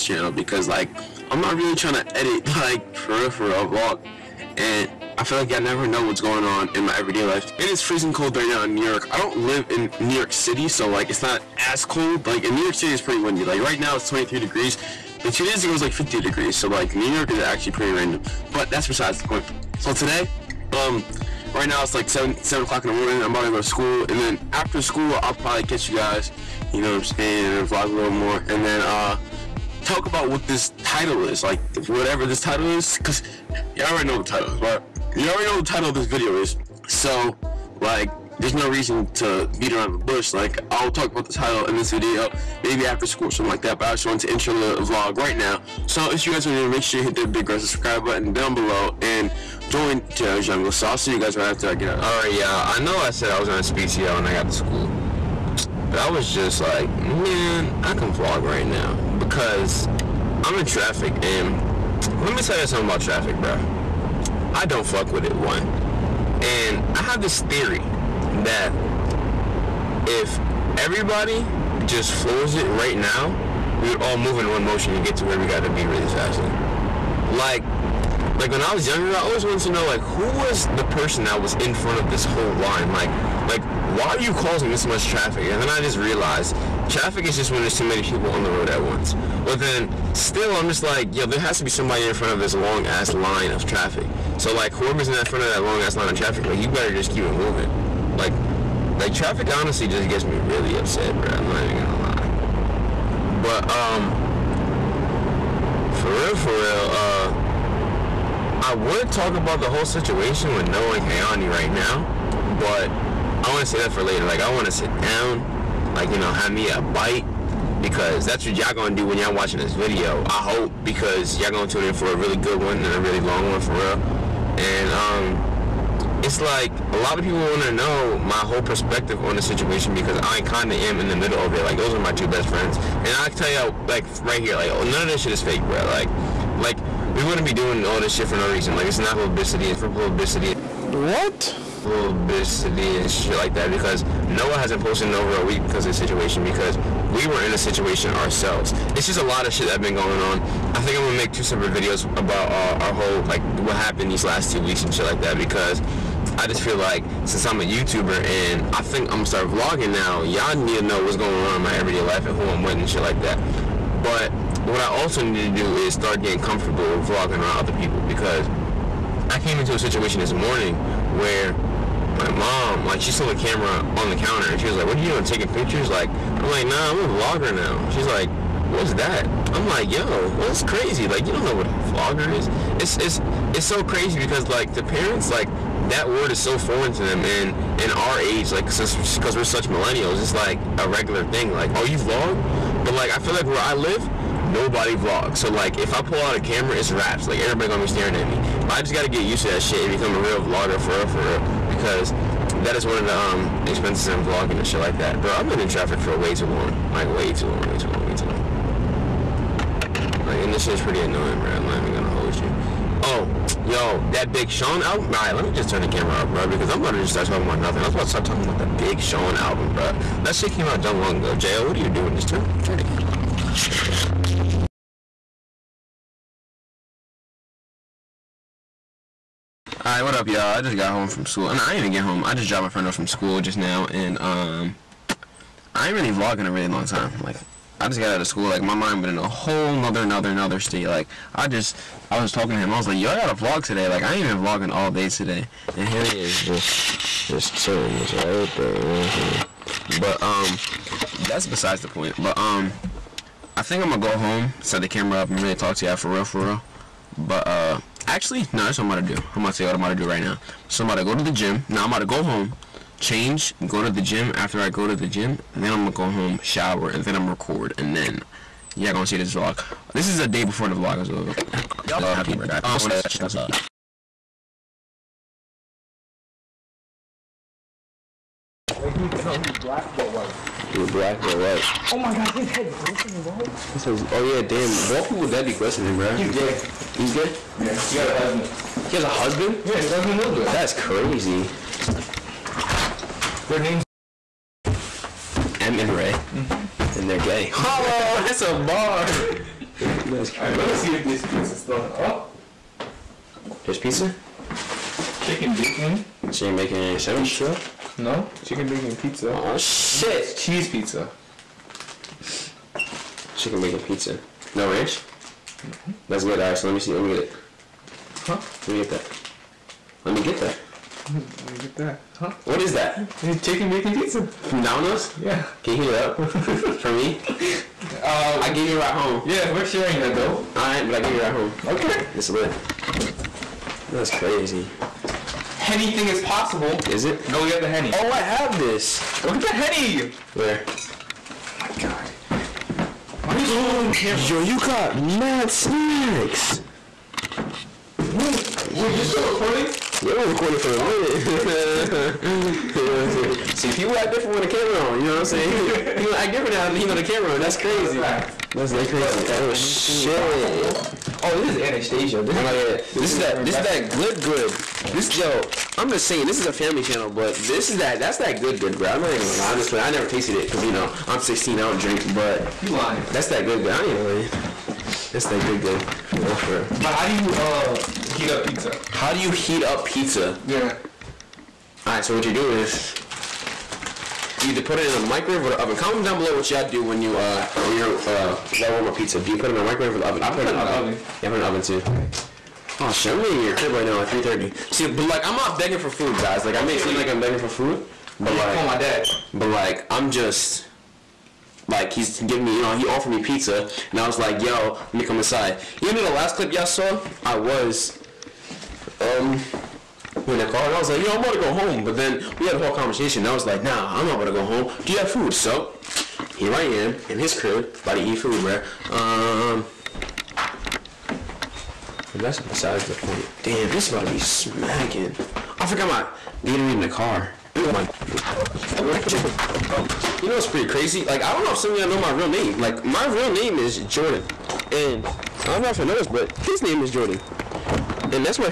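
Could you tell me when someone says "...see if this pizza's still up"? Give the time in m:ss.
5:00.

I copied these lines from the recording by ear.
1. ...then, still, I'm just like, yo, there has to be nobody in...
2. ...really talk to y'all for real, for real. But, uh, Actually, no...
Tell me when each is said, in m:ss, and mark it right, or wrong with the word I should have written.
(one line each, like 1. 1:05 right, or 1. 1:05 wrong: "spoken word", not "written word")
1. 1:29 wrong: "somebody", not "nobody"
2. 4:15 right.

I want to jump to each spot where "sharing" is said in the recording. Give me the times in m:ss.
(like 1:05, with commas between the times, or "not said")
5:29.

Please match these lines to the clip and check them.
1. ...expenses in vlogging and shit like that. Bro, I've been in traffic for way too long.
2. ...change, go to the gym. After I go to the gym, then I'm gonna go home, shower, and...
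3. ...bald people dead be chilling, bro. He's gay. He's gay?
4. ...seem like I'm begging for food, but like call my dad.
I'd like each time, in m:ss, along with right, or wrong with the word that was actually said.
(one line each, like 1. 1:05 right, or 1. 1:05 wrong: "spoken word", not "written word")
1. 3:23 right
2. 4:22 right
3. 4:44 wrong: "glistening", not "chilling"
4. 6:36 right.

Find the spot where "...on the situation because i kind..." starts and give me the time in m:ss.
2:09.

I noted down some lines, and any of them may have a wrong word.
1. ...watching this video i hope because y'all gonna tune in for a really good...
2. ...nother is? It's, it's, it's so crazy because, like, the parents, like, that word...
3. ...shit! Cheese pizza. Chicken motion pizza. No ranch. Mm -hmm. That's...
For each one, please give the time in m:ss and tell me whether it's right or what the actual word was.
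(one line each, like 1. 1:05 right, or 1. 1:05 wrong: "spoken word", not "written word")
1. 1:59 right
2. 3:01 wrong: "vlogger", not "nother"
3. 5:09 wrong: "bacon", not "motion".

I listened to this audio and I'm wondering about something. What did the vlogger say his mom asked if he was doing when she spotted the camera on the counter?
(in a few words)
Taking pictures.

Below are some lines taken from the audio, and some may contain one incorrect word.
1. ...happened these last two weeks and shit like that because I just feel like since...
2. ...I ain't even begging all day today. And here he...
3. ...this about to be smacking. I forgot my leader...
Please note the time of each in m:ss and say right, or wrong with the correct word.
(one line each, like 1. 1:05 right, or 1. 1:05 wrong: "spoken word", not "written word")
1. 2:33 right
2. 4:04 wrong: "vlogging", not "begging"
3. 7:03 right.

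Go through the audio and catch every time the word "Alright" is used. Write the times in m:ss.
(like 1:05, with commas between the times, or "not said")
0:52, 3:49.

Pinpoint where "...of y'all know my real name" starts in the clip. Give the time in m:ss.
7:11.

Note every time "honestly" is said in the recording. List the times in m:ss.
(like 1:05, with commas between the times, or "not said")
1:39, 6:09.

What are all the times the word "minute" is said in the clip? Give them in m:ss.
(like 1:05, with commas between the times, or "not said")
5:50.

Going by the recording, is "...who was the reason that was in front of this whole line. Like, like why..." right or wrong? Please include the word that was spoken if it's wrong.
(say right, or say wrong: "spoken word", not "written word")
wrong: "person", not "reason".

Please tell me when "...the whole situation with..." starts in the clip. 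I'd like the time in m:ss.
1:49.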